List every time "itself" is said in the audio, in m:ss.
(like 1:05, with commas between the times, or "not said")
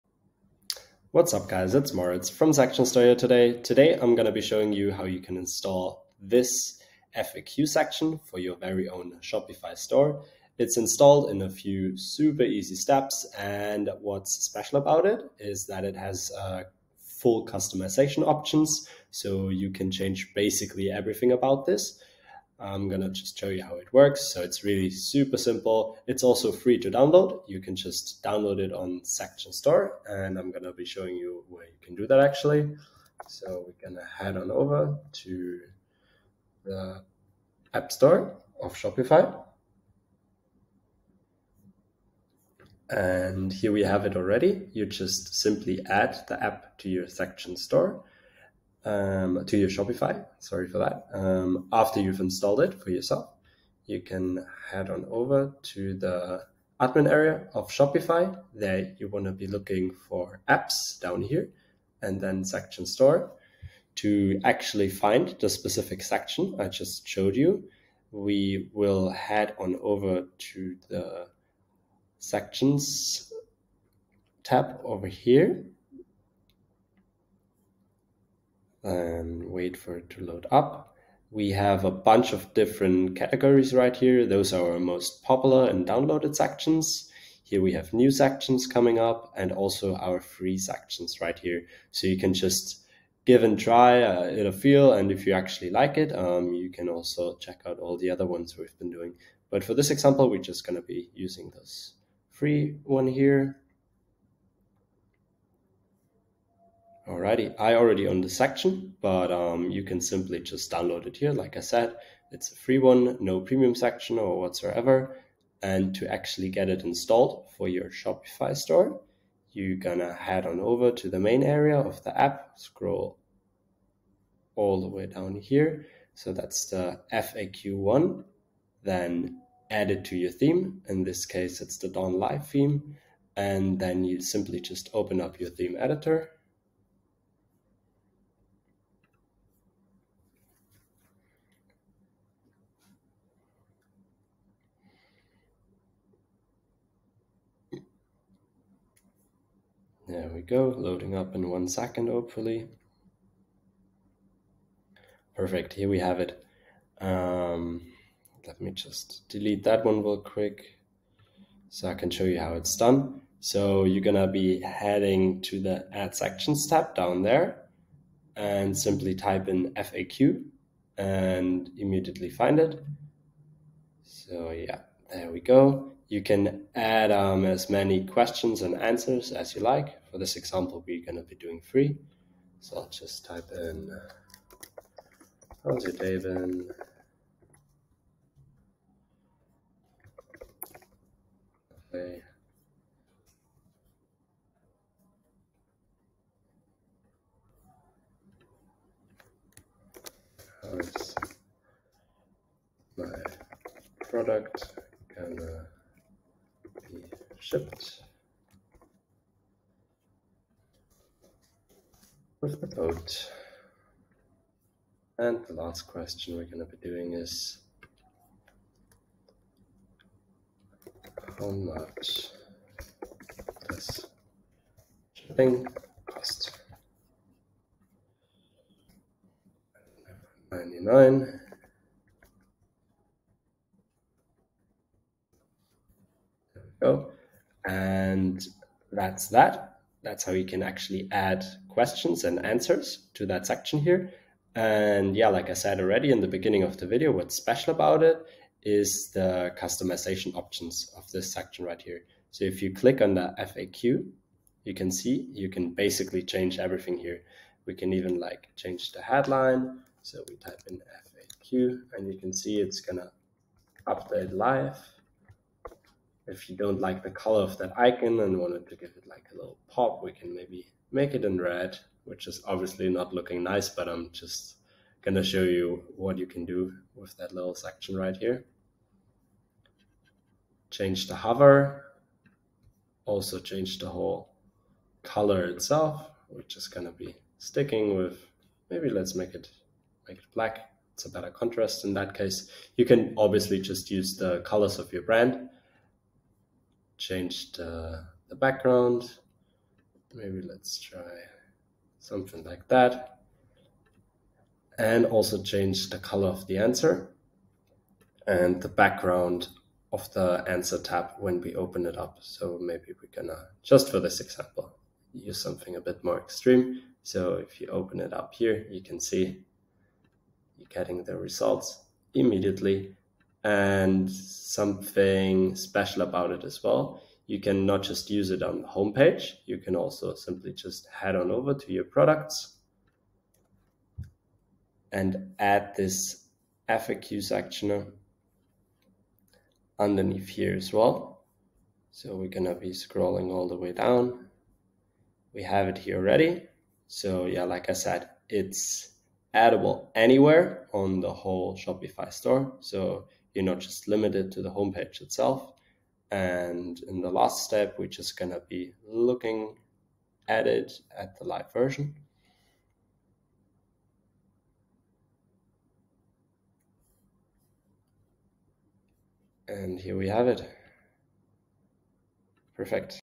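4:45, 5:55.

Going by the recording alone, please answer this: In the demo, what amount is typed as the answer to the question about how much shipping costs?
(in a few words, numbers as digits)
99.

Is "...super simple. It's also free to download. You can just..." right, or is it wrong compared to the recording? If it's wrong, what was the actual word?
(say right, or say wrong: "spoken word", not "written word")
right.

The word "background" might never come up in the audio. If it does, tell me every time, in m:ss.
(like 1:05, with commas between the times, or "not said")
4:58, 5:08.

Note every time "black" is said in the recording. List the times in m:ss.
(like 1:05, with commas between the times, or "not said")
4:50.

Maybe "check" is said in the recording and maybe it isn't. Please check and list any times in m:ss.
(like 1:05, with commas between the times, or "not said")
1:37.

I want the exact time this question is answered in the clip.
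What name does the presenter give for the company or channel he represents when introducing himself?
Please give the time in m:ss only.
0:02.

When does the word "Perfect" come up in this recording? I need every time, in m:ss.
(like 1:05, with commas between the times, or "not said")
2:35, 6:12.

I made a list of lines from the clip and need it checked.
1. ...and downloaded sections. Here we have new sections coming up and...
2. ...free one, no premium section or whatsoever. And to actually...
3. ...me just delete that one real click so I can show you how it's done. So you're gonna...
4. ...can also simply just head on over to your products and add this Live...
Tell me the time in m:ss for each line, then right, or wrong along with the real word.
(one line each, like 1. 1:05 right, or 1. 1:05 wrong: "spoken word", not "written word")
1. 1:25 right
2. 1:52 right
3. 2:38 wrong: "quick", not "click"
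4. 5:29 wrong: "FAQ", not "Live".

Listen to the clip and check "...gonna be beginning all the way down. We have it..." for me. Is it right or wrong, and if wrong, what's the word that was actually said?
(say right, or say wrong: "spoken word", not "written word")
wrong: "scrolling", not "beginning".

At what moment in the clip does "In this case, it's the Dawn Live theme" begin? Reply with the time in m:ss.
2:10.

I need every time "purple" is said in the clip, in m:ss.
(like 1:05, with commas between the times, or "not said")
not said.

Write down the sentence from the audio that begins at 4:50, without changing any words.
It's a better contrast in that case.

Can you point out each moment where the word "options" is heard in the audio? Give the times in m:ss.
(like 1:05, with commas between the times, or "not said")
0:18, 4:10.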